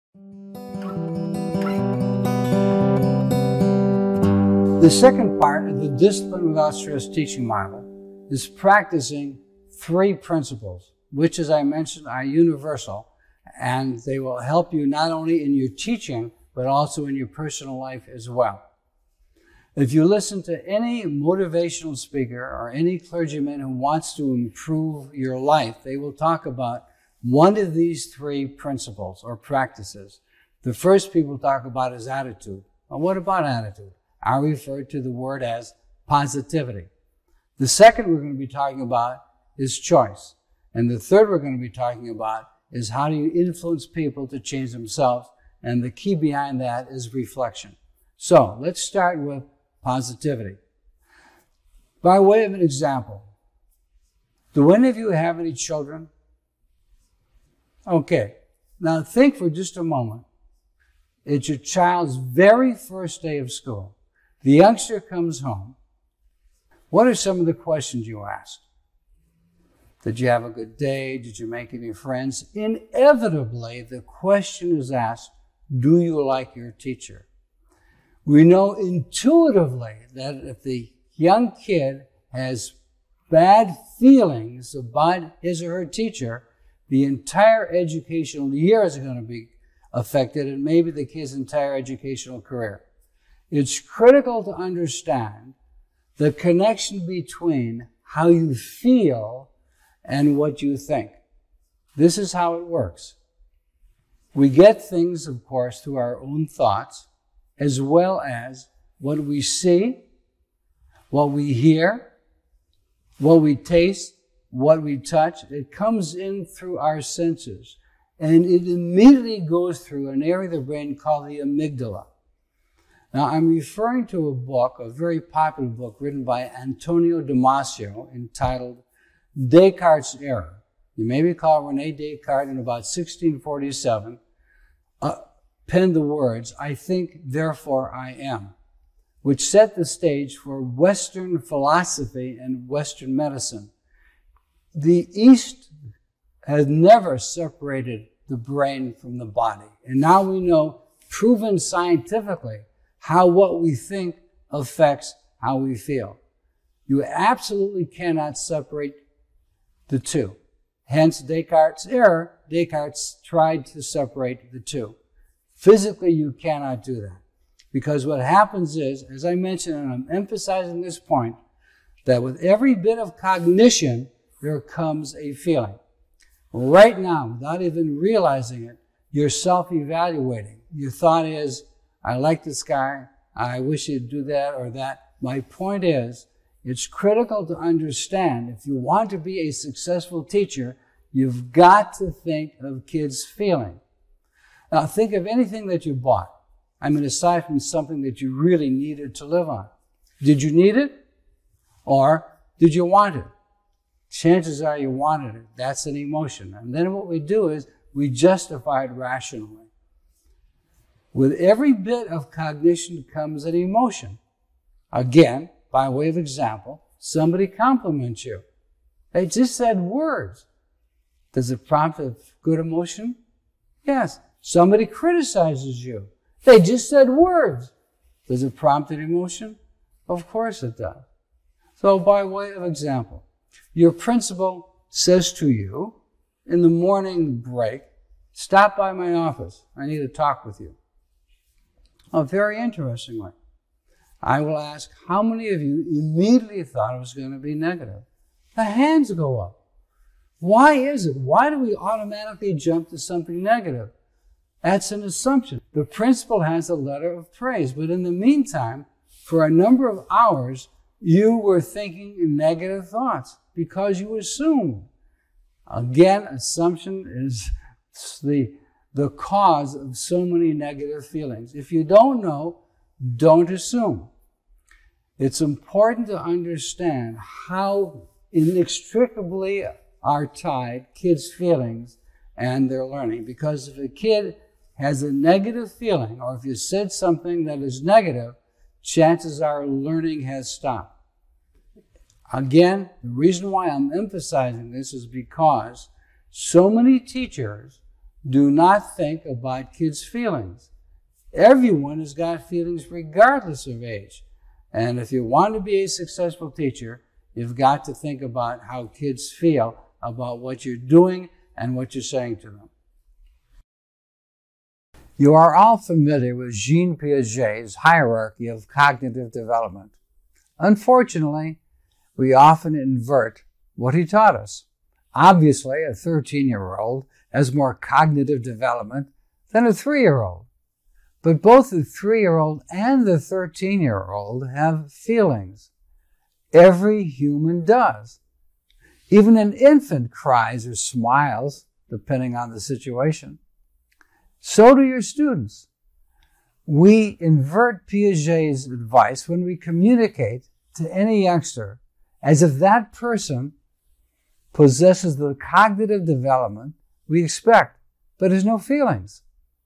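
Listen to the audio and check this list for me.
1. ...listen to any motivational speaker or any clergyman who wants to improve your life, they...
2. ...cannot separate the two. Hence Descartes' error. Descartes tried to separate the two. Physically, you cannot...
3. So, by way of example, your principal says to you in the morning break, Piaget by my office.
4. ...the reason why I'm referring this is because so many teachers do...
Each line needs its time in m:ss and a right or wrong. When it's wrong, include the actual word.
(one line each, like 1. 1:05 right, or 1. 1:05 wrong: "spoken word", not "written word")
1. 0:20 right
2. 2:37 right
3. 3:51 wrong: "Stop", not "Piaget"
4. 4:53 wrong: "emphasizing", not "referring".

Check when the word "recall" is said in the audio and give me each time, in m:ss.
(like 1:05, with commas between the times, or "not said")
2:11.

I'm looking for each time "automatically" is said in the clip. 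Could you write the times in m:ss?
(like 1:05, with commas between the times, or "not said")
4:11.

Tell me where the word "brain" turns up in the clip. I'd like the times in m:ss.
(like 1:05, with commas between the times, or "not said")
2:00, 2:28.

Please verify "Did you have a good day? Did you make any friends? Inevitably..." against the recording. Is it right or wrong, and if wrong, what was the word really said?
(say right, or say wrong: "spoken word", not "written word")
right.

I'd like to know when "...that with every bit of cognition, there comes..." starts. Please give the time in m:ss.
2:52.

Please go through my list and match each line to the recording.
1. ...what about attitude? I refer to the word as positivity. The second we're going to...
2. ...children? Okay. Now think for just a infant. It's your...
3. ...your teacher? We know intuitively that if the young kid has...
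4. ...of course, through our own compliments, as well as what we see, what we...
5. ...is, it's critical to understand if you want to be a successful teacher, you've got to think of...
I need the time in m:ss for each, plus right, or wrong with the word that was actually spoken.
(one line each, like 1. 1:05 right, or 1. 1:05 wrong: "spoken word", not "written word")
1. 0:32 right
2. 0:55 wrong: "moment", not "infant"
3. 1:16 right
4. 1:45 wrong: "thoughts", not "compliments"
5. 3:05 right.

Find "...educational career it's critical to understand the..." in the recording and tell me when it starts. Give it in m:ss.
1:31.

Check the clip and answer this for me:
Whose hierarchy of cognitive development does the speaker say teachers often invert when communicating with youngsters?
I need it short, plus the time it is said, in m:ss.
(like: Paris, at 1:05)
Jean Piaget, at 5:16.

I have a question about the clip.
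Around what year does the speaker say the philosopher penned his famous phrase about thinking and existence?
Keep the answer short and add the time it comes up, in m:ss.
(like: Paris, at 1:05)
1647, at 2:12.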